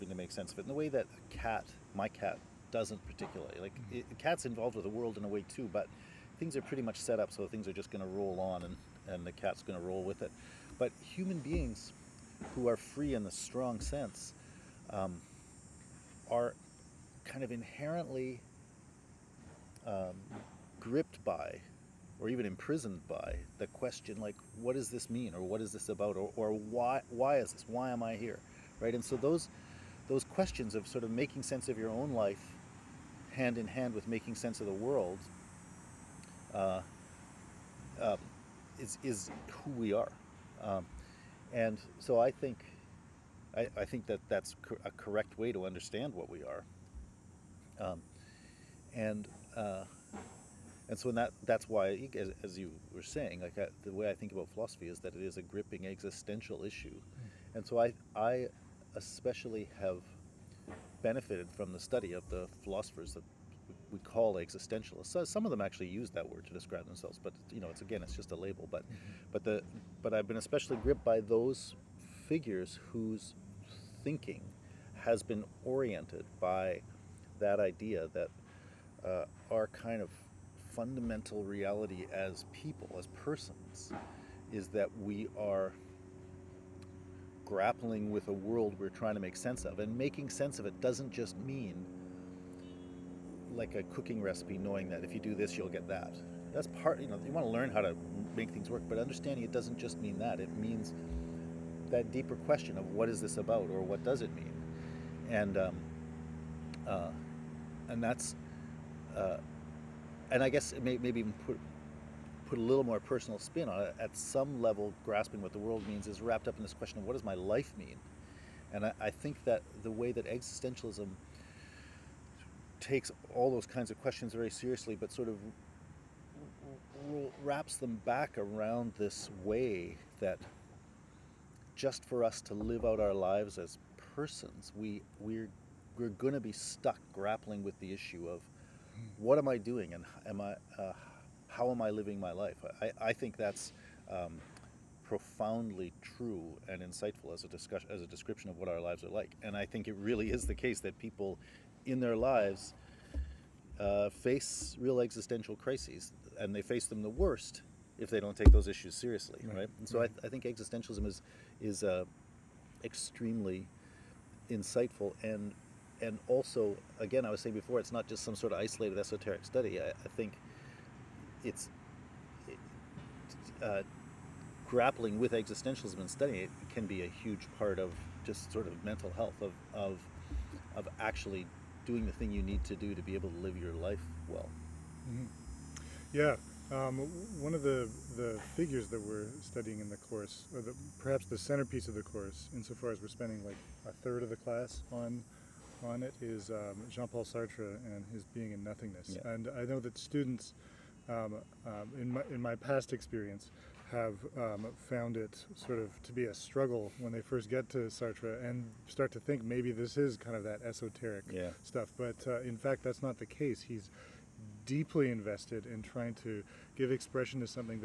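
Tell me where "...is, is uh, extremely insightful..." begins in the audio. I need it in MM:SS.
02:41.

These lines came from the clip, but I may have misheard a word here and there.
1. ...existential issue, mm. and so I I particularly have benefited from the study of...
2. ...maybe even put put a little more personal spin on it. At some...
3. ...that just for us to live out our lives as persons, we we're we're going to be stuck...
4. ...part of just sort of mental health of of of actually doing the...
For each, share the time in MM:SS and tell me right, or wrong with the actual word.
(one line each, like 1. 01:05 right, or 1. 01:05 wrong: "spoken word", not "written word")
1. 00:55 wrong: "especially", not "particularly"
2. 01:50 right
3. 02:10 right
4. 02:57 right.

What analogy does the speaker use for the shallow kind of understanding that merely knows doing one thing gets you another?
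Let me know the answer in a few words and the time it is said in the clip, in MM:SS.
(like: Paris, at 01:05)
a cooking recipe, at 01:33.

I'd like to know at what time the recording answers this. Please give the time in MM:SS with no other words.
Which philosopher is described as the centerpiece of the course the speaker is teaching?
03:16.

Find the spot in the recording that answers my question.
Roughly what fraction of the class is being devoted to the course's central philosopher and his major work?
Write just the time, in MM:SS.
03:13.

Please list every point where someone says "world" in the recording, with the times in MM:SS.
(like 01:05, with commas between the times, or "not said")
00:04, 00:34, 01:28, 01:55.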